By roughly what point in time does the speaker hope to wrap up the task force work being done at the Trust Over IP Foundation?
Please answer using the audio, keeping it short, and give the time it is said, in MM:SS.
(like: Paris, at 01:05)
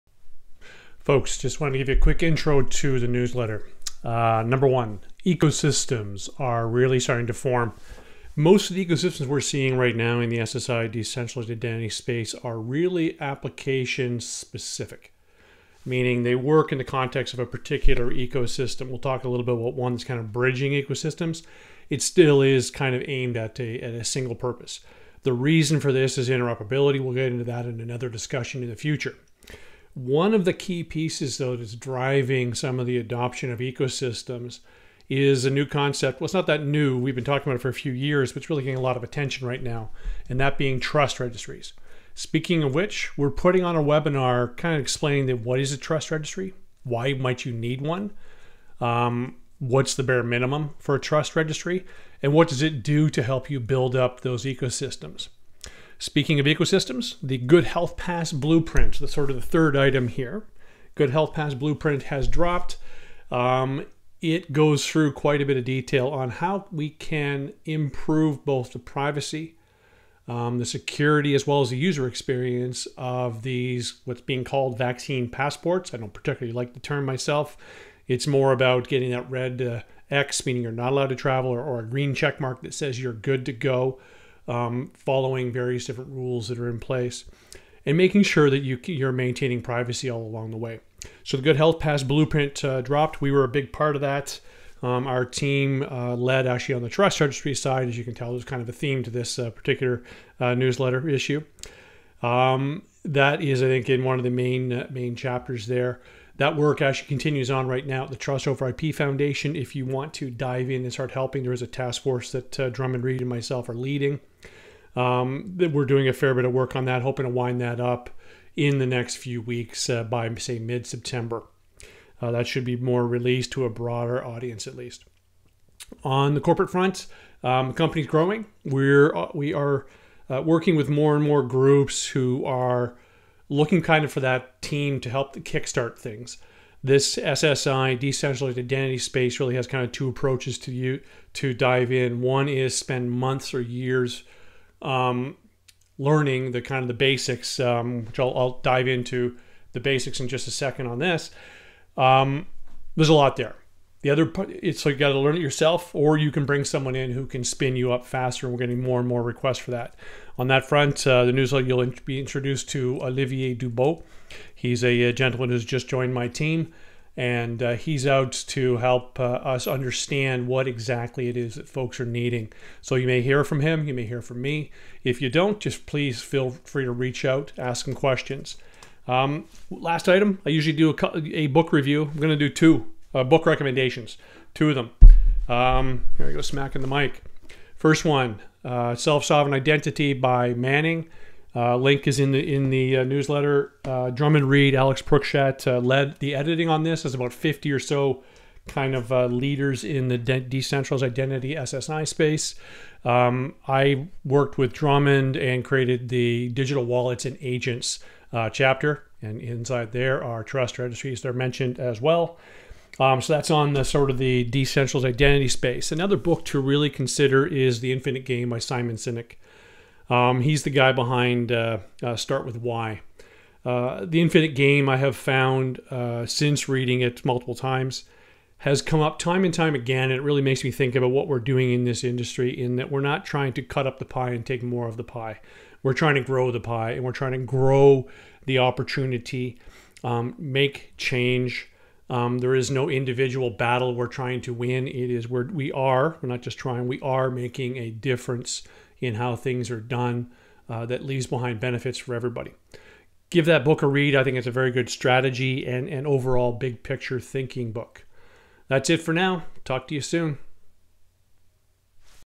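Mid September, at 02:00.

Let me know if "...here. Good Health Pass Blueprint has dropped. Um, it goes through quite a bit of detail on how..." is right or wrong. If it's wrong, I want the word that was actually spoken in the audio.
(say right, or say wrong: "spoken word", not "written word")
right.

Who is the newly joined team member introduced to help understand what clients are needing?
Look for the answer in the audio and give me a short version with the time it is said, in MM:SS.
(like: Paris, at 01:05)
Olivier Dubois, at 02:43.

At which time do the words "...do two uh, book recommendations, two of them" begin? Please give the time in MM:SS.
03:02.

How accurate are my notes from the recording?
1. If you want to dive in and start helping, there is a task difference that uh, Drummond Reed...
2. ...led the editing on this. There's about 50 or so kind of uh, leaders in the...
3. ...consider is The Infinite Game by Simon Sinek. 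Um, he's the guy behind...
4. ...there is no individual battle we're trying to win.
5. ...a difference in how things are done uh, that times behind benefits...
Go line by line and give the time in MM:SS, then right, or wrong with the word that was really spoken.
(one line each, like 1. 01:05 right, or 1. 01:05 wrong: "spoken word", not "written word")
1. 01:49 wrong: "force", not "difference"
2. 03:15 right
3. 03:36 right
4. 04:02 right
5. 04:07 wrong: "leaves", not "times".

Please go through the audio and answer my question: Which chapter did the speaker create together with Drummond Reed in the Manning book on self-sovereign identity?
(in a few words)
Digital wallets and agents.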